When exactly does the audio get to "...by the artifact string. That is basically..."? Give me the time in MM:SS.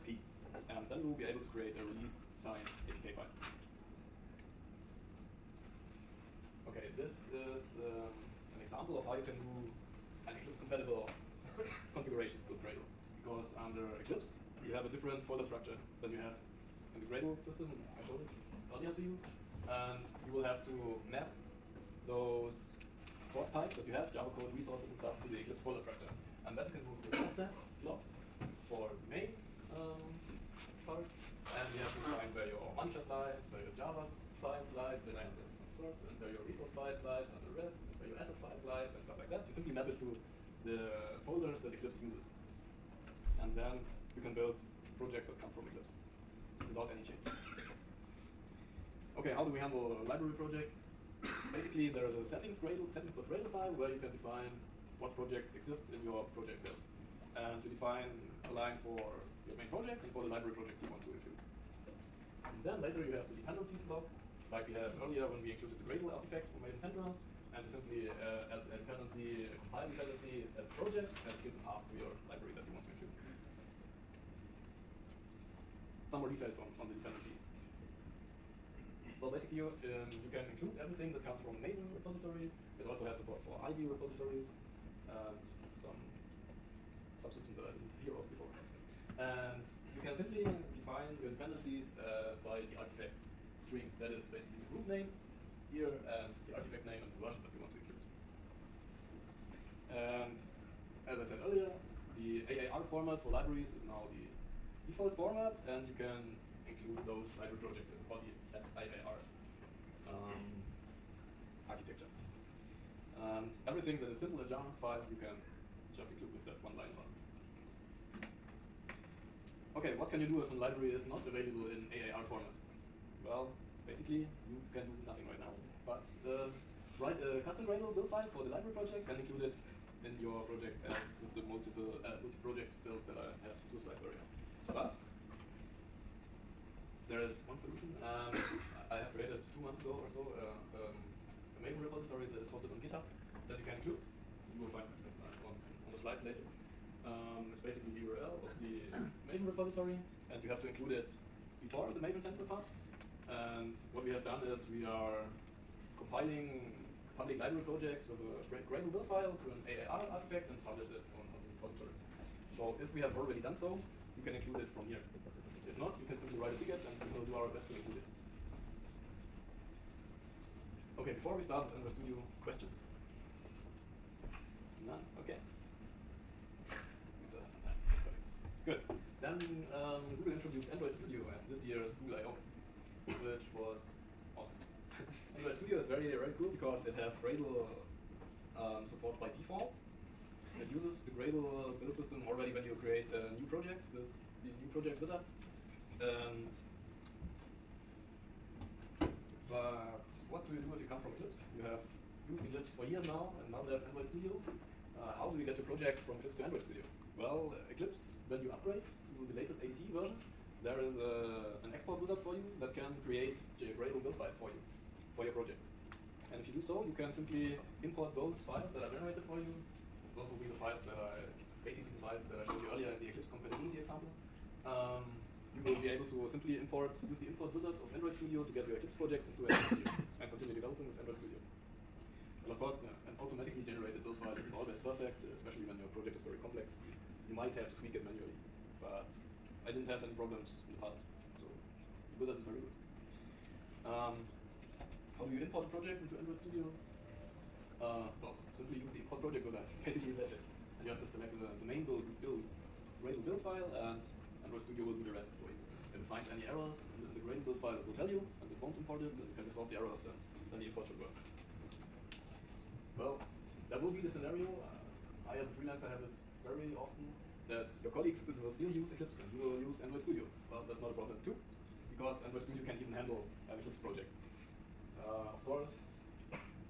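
01:32.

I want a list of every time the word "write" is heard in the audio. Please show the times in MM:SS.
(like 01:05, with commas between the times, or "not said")
02:06, 02:46.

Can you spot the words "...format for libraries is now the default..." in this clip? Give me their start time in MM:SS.
01:42.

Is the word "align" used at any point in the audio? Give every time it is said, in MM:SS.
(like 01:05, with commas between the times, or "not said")
00:58.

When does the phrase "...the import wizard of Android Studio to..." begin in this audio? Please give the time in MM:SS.
03:47.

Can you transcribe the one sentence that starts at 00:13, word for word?
Because under Eclipse, you have a different folder structure than you have the Gradle system.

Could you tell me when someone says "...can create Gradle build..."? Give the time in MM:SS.
03:32.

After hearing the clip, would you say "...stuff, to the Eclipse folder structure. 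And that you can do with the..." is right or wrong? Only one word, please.
right.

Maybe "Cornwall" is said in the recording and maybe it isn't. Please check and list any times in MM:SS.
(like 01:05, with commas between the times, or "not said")
not said.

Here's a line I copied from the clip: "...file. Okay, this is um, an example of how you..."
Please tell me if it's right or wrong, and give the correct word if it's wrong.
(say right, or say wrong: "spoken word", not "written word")
right.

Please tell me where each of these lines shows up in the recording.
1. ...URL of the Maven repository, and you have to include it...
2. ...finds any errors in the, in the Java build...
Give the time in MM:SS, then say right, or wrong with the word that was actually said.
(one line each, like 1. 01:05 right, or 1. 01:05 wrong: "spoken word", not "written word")
1. 02:28 right
2. 04:16 wrong: "Gradle", not "Java".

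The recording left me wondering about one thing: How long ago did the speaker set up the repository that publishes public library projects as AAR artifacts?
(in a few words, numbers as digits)
two months ago.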